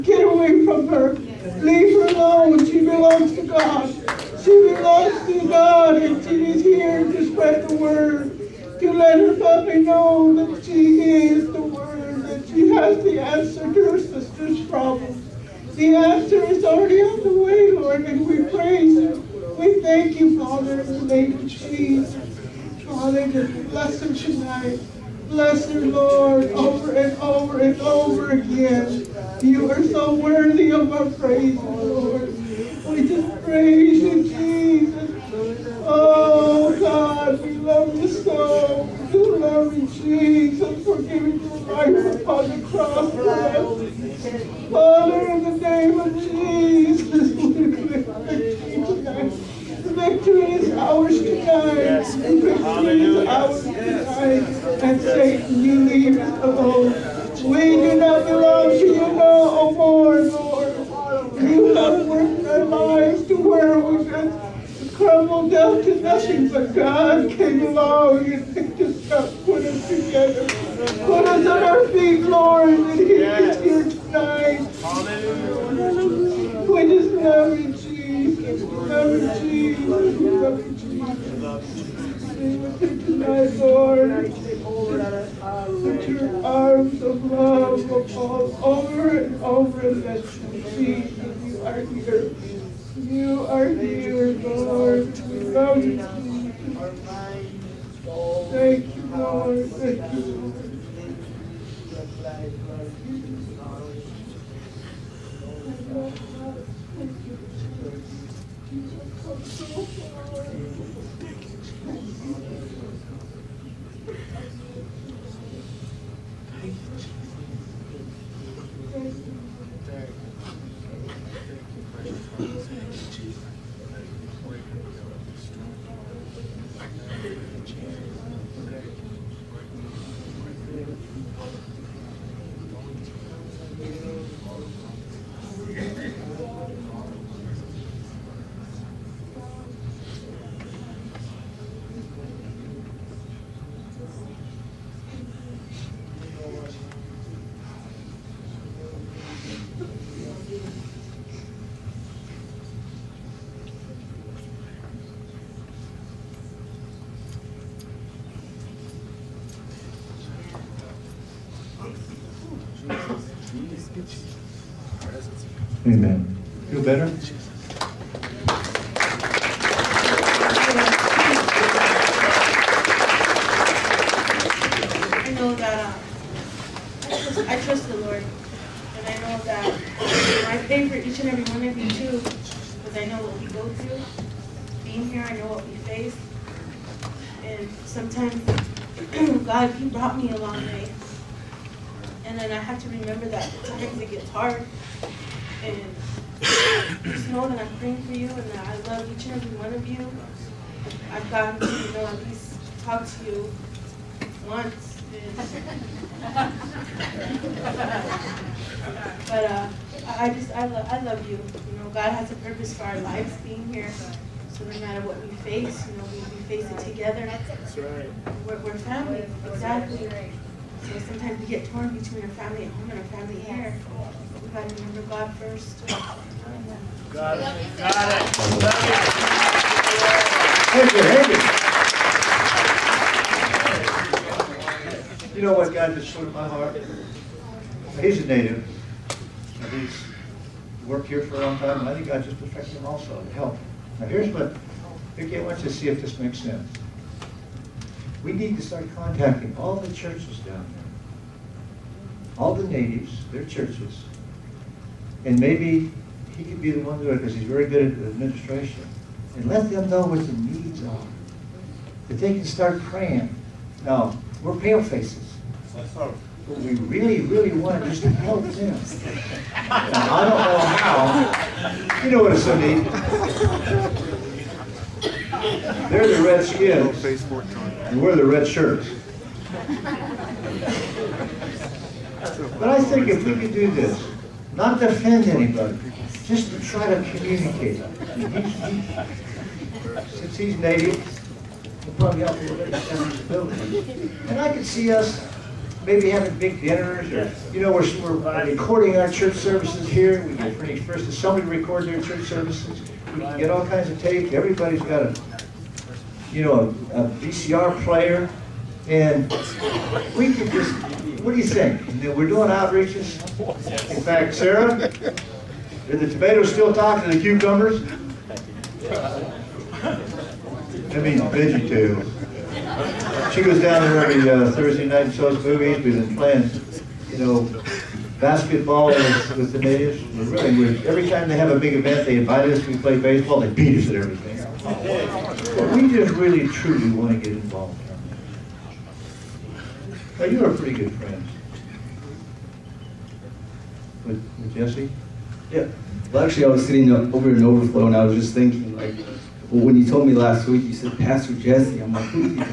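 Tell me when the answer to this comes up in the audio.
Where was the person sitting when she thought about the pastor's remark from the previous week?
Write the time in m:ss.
5:47.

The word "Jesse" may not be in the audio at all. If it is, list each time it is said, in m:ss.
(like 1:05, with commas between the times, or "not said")
5:44, 5:51.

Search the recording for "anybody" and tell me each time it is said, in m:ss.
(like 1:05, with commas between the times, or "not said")
4:45.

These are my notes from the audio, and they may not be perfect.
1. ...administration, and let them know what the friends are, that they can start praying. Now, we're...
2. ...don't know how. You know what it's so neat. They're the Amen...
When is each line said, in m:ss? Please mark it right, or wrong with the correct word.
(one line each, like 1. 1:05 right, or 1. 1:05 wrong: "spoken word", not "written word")
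1. 4:17 wrong: "needs", not "friends"
2. 4:30 wrong: "Redskins", not "Amen".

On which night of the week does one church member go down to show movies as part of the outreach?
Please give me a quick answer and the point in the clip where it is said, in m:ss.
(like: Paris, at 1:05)
Thursday, at 5:24.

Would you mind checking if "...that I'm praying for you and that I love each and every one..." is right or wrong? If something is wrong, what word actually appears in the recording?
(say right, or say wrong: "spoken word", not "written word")
right.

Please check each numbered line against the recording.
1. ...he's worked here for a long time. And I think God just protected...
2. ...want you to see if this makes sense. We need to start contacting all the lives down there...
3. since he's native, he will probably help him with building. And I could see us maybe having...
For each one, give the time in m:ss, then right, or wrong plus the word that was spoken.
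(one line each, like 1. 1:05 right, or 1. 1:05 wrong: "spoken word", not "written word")
1. 3:59 right
2. 4:05 wrong: "churches", not "lives"
3. 4:50 right.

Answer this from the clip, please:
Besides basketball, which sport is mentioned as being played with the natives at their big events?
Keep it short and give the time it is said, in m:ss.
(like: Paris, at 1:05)
baseball, at 5:32.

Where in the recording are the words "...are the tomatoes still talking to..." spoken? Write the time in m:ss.
5:14.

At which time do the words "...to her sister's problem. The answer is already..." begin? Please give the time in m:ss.
0:13.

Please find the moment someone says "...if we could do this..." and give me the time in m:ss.
4:43.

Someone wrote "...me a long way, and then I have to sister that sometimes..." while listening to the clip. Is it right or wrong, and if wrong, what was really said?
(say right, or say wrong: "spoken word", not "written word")
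wrong: "remember", not "sister".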